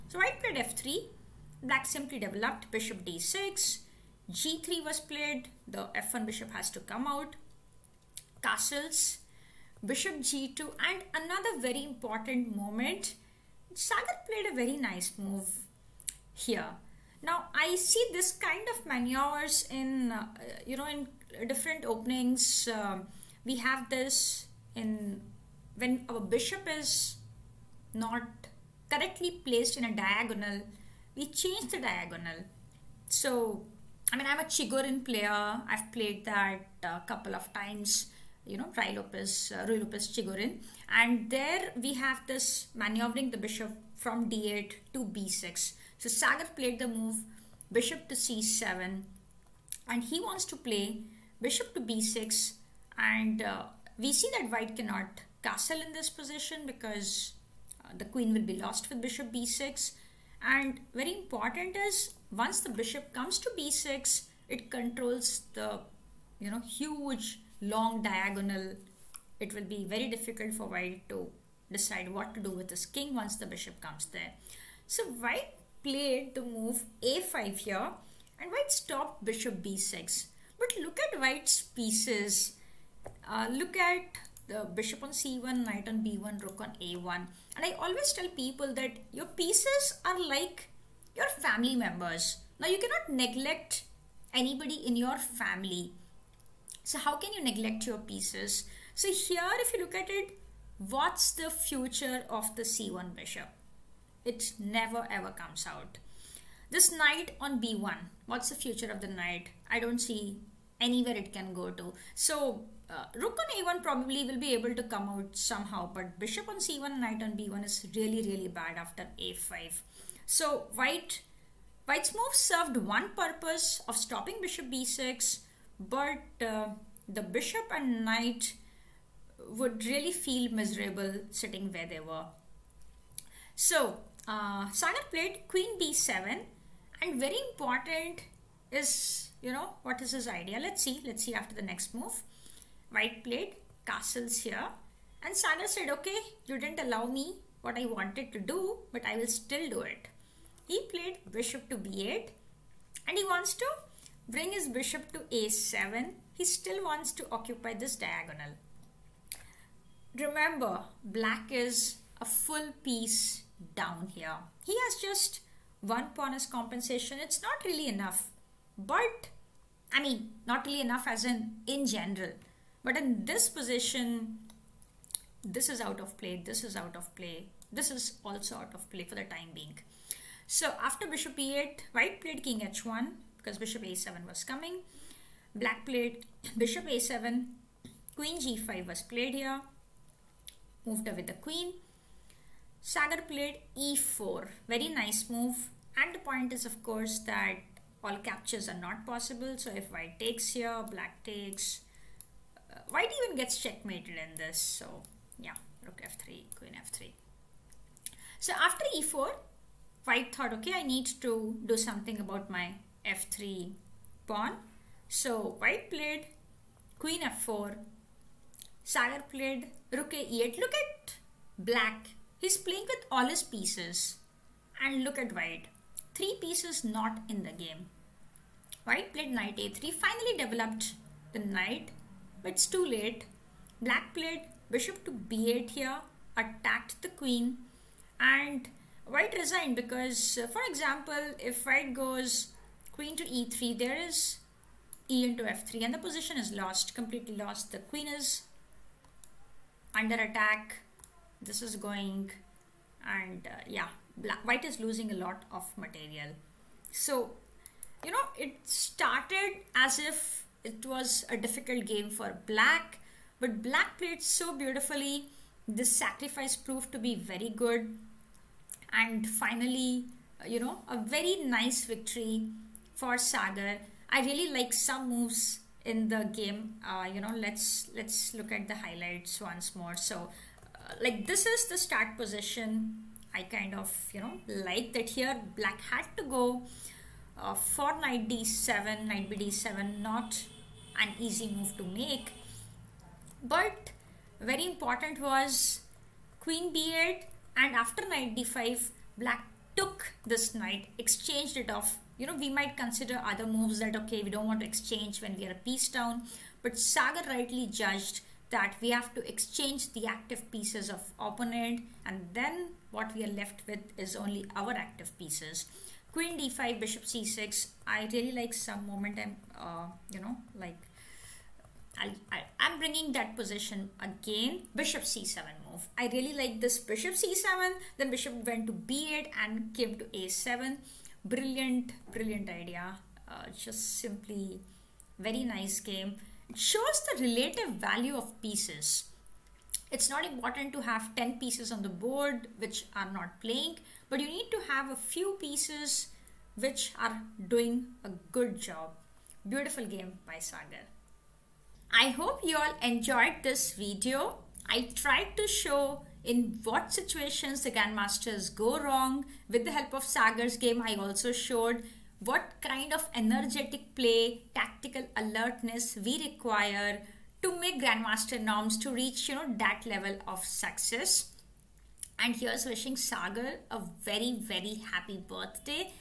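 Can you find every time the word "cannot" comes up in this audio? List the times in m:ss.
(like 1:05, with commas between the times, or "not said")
0:54, 1:32.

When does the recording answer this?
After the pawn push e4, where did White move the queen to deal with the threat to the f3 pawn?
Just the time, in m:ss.
3:36.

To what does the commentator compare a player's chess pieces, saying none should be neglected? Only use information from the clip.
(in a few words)
Family members.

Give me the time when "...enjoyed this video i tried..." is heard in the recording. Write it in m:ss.
5:52.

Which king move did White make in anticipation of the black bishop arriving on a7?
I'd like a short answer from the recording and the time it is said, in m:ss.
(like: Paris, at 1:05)
King h1, at 3:02.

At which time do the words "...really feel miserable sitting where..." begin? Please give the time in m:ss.
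2:09.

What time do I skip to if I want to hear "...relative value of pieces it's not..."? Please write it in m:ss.
5:37.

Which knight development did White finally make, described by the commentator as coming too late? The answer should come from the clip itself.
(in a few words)
Knight a3.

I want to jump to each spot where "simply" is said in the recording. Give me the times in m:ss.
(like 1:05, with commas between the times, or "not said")
0:01, 5:33.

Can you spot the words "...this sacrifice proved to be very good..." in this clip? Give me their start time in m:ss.
4:25.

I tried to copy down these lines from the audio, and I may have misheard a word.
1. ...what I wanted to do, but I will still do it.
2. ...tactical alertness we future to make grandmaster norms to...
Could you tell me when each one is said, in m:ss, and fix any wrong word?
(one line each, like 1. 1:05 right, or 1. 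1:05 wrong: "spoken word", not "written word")
1. 2:27 right
2. 6:04 wrong: "require", not "future".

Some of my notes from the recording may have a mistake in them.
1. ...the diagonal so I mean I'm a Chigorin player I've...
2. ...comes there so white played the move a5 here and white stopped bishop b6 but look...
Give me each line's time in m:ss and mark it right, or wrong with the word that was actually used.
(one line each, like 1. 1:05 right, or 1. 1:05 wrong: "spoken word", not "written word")
1. 0:31 right
2. 1:13 right.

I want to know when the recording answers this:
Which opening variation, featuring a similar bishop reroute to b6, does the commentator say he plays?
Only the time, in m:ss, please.
0:39.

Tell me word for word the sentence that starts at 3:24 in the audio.
So yeah, rook f3, queen f3.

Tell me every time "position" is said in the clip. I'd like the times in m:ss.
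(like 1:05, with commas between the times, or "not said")
0:56, 2:53, 4:06, 4:42, 5:23.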